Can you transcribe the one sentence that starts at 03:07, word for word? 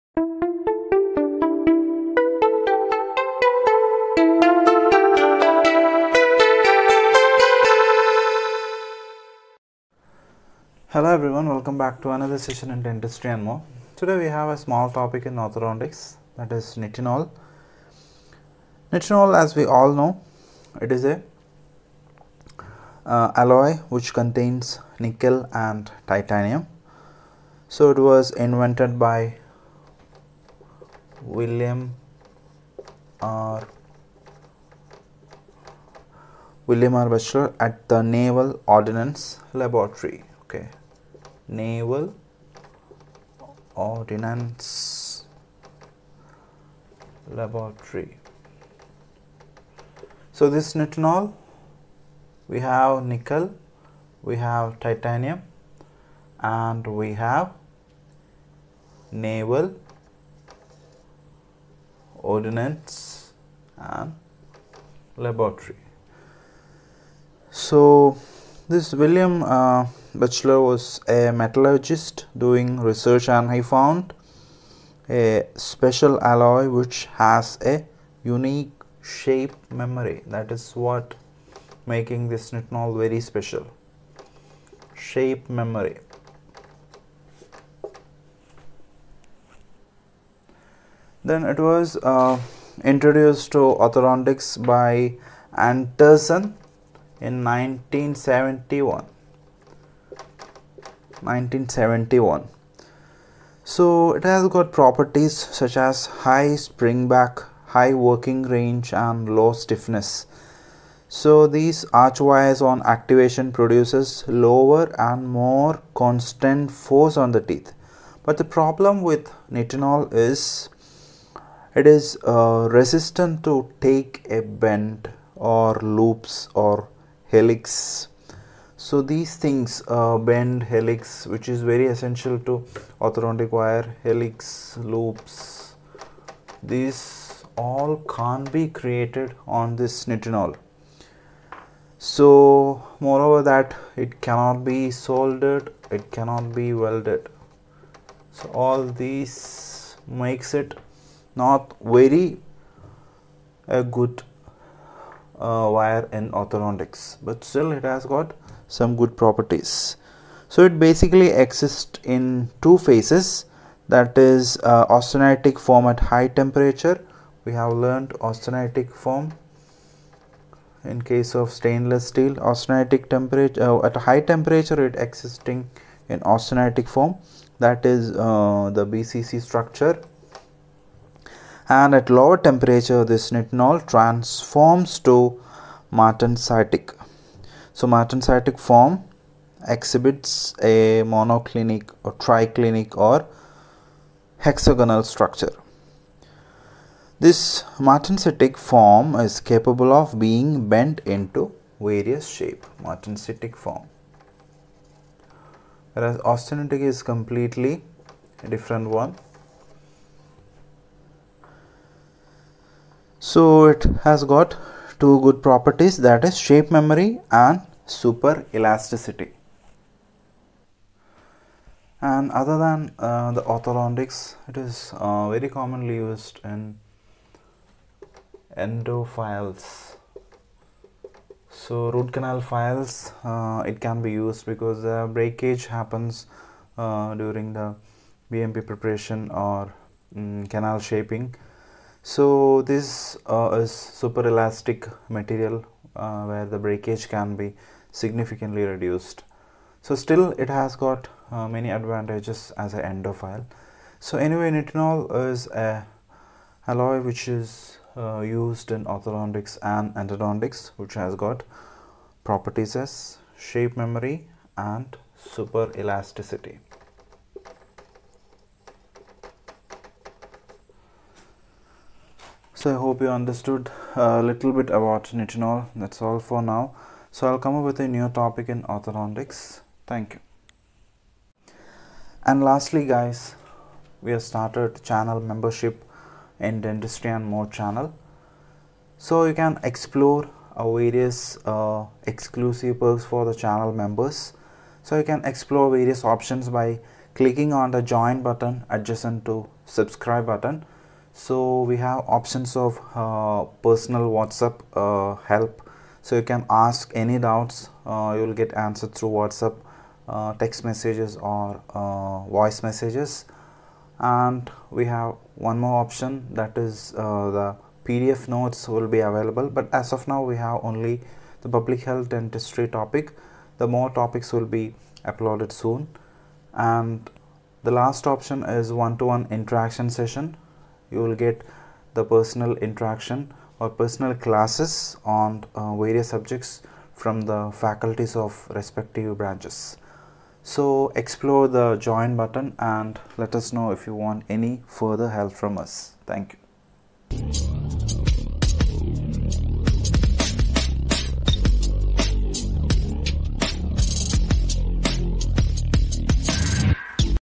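So martensitic form exhibits a monoclinic or triclinic or hexagonal structure.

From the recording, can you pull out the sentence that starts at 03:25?
Whereas austenitic is completely different one.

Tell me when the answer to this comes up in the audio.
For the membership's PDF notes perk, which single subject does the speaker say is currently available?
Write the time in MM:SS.
05:21.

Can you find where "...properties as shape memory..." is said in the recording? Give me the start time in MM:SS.
04:22.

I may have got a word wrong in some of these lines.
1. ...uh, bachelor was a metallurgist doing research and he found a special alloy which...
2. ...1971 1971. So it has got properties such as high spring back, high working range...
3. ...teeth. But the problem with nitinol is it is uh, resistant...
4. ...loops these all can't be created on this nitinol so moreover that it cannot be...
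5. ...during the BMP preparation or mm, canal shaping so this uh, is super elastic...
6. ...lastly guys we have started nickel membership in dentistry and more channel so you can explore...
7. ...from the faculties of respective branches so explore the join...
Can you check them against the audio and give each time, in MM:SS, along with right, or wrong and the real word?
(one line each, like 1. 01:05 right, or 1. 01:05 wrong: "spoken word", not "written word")
1. 01:09 right
2. 01:37 right
3. 01:57 right
4. 02:14 right
5. 03:57 right
6. 04:42 wrong: "channel", not "nickel"
7. 05:36 right.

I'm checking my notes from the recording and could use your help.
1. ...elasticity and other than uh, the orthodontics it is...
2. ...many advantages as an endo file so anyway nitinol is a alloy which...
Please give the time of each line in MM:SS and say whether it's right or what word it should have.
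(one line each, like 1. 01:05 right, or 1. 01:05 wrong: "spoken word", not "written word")
1. 03:38 right
2. 04:11 right.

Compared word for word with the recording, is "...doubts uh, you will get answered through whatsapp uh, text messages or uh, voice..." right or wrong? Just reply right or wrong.
right.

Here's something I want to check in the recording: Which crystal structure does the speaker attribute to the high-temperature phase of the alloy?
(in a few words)
BCC.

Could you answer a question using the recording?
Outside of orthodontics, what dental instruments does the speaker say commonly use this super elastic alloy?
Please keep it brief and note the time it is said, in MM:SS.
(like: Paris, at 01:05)
Endo files, at 03:48.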